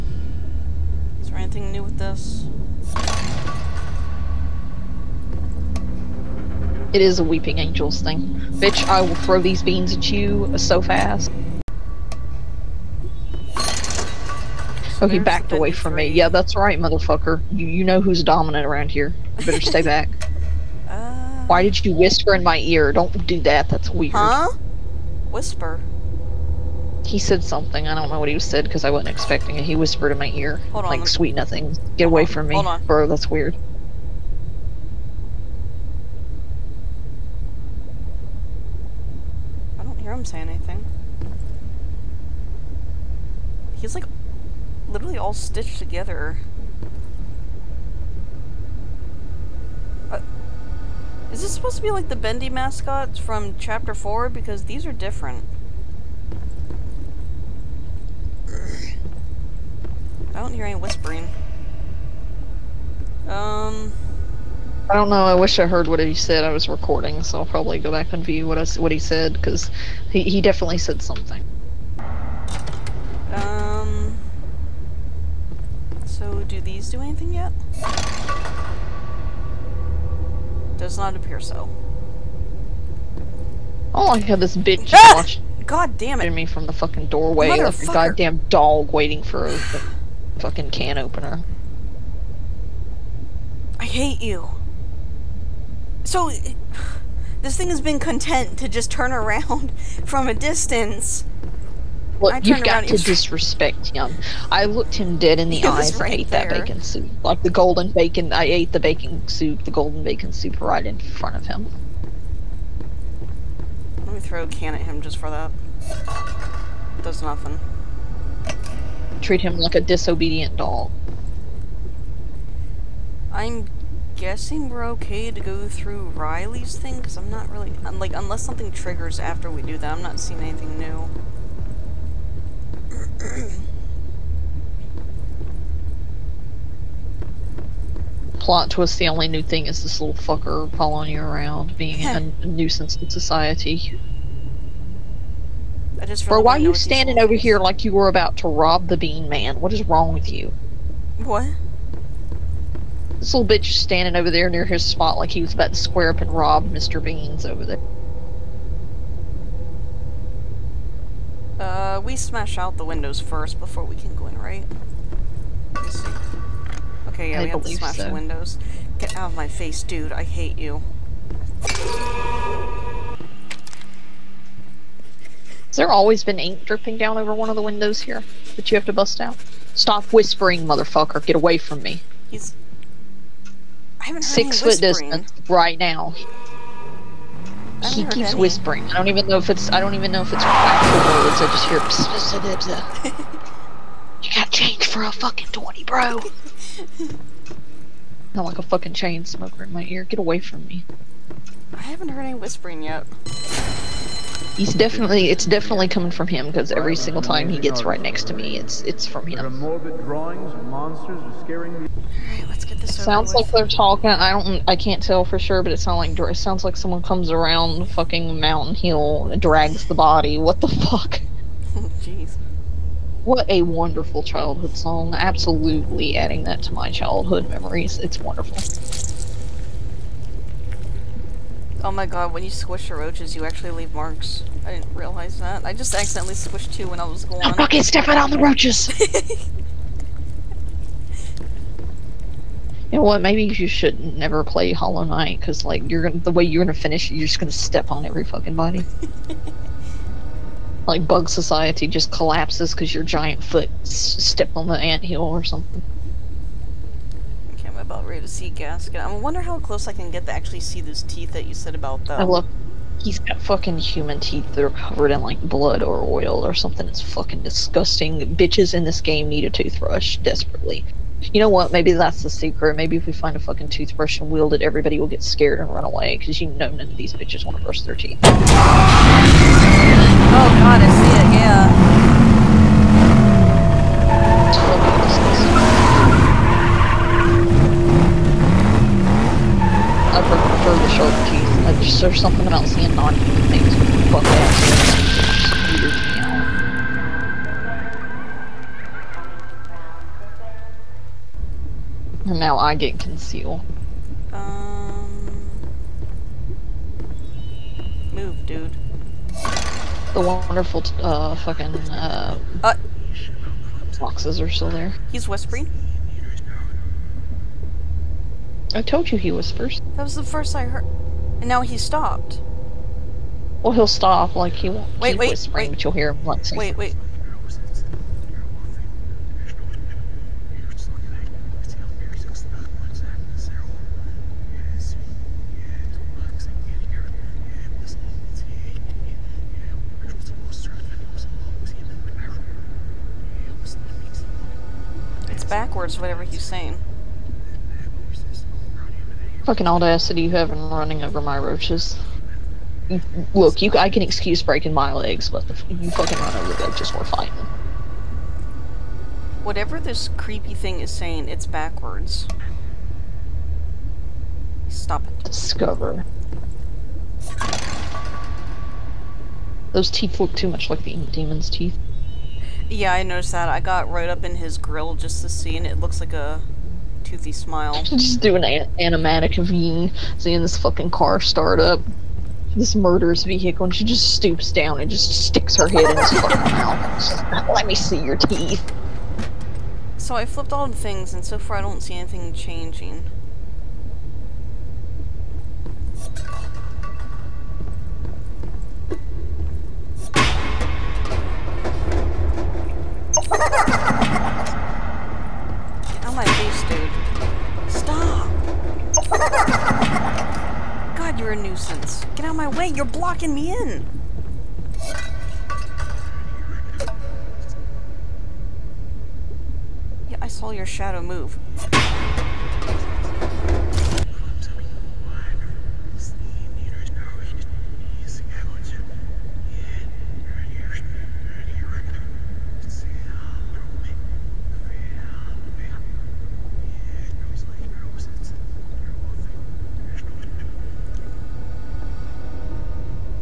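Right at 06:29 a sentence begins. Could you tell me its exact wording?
So I flipped all the things, and so far I don't see anything changing.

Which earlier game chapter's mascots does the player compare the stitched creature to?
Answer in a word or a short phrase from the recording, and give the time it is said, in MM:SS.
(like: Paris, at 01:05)
Chapter 4, at 00:53.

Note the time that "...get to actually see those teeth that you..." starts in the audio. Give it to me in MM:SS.
04:20.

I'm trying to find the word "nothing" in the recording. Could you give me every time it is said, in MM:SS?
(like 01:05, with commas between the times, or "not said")
00:31, 01:57.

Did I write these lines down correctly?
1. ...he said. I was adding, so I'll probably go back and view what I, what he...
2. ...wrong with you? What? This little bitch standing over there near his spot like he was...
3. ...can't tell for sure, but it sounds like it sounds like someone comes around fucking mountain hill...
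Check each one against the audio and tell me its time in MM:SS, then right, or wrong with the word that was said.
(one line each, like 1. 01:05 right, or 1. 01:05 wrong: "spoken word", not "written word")
1. 01:05 wrong: "recording", not "adding"
2. 02:29 right
3. 03:34 right.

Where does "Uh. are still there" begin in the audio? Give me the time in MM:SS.
05:12.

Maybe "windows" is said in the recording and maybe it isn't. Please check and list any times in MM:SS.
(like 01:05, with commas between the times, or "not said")
02:42, 02:48, 02:57.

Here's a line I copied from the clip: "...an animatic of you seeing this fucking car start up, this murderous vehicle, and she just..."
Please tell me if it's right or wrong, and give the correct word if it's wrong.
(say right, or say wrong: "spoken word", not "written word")
right.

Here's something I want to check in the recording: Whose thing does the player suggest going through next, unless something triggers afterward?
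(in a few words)
Riley's.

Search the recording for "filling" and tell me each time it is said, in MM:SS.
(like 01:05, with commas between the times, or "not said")
not said.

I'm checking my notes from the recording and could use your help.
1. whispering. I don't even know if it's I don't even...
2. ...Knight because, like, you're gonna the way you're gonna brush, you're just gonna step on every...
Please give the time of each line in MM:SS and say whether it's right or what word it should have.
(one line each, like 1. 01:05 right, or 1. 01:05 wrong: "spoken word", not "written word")
1. 03:08 right
2. 04:05 wrong: "finish", not "brush".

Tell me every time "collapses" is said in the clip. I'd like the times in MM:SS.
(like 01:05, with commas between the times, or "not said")
04:12.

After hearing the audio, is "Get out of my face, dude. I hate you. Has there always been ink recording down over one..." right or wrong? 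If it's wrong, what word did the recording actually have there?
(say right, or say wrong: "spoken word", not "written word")
wrong: "dripping", not "recording".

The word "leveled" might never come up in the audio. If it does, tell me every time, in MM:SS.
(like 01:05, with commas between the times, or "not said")
not said.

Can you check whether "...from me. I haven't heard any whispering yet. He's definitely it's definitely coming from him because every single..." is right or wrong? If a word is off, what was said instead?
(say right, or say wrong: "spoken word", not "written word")
right.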